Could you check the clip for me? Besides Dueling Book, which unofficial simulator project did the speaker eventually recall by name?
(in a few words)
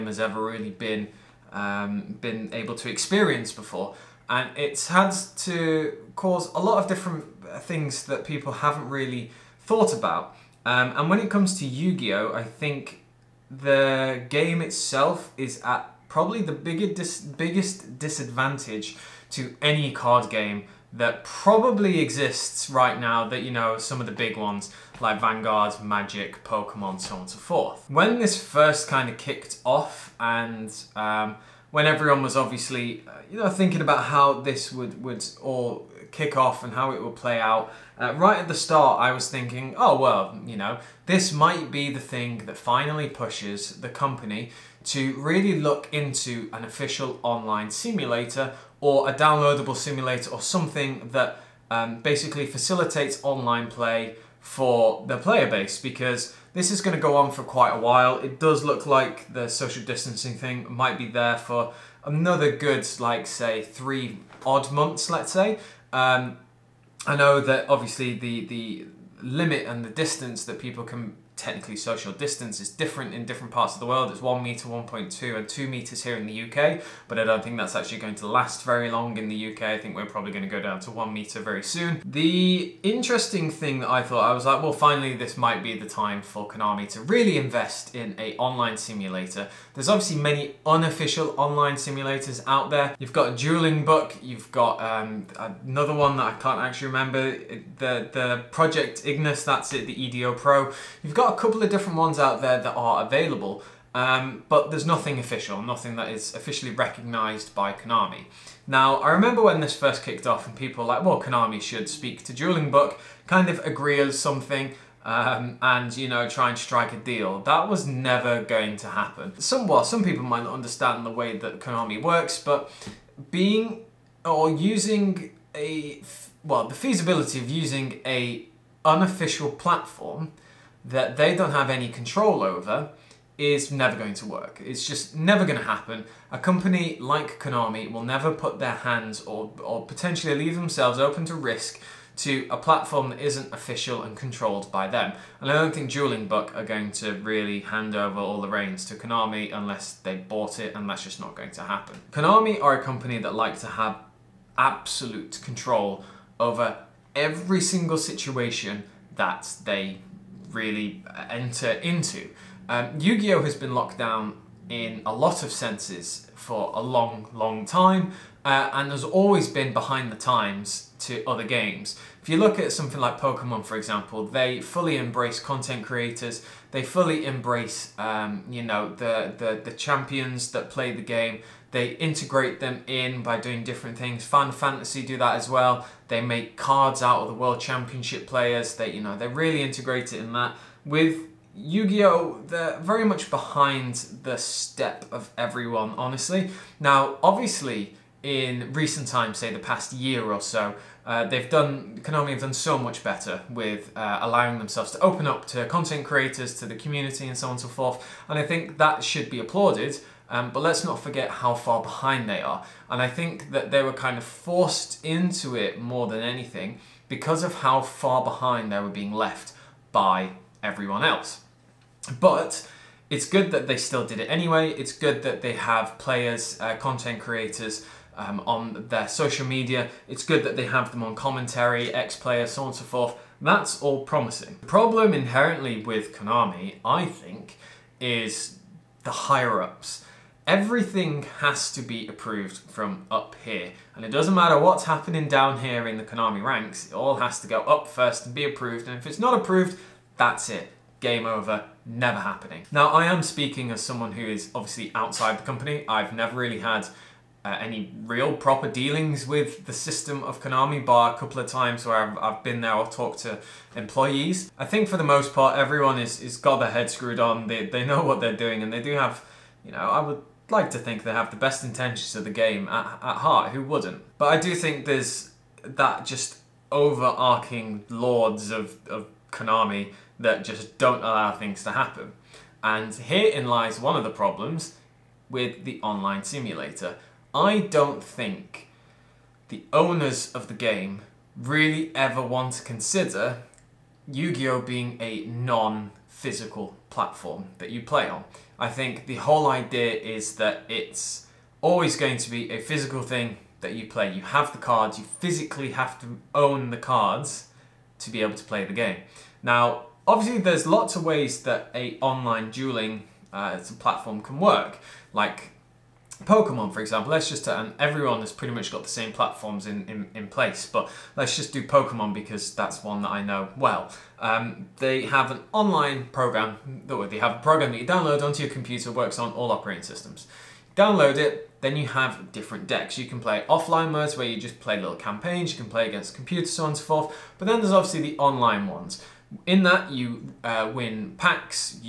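Project Ignis.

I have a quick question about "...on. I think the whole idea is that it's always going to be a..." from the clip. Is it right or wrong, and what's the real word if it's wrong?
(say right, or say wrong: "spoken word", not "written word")
right.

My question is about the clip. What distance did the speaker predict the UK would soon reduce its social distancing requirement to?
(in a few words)
1 meter.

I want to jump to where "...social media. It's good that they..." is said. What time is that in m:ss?
3:49.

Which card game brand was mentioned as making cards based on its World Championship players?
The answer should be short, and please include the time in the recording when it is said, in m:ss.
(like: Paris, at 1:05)
Fantasy, at 3:04.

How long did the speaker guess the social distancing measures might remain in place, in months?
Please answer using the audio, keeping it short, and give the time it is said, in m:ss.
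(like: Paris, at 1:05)
3 months, at 1:03.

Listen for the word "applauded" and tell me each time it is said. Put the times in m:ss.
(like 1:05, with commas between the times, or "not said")
3:29.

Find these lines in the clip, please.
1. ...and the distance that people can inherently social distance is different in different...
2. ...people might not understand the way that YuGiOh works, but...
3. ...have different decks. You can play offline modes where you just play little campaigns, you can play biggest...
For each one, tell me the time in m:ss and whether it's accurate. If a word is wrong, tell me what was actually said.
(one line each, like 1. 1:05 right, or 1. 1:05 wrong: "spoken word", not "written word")
1. 1:09 wrong: "technically", not "inherently"
2. 2:00 wrong: "Konami", not "YuGiOh"
3. 5:31 wrong: "against", not "biggest".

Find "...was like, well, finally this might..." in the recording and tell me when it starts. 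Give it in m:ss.
1:24.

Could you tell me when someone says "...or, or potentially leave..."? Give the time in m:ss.
2:19.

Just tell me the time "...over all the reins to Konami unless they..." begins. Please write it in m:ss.
2:27.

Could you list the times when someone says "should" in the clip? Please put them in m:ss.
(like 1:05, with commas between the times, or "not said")
1:51, 3:29.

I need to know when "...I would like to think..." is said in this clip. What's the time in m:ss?
4:29.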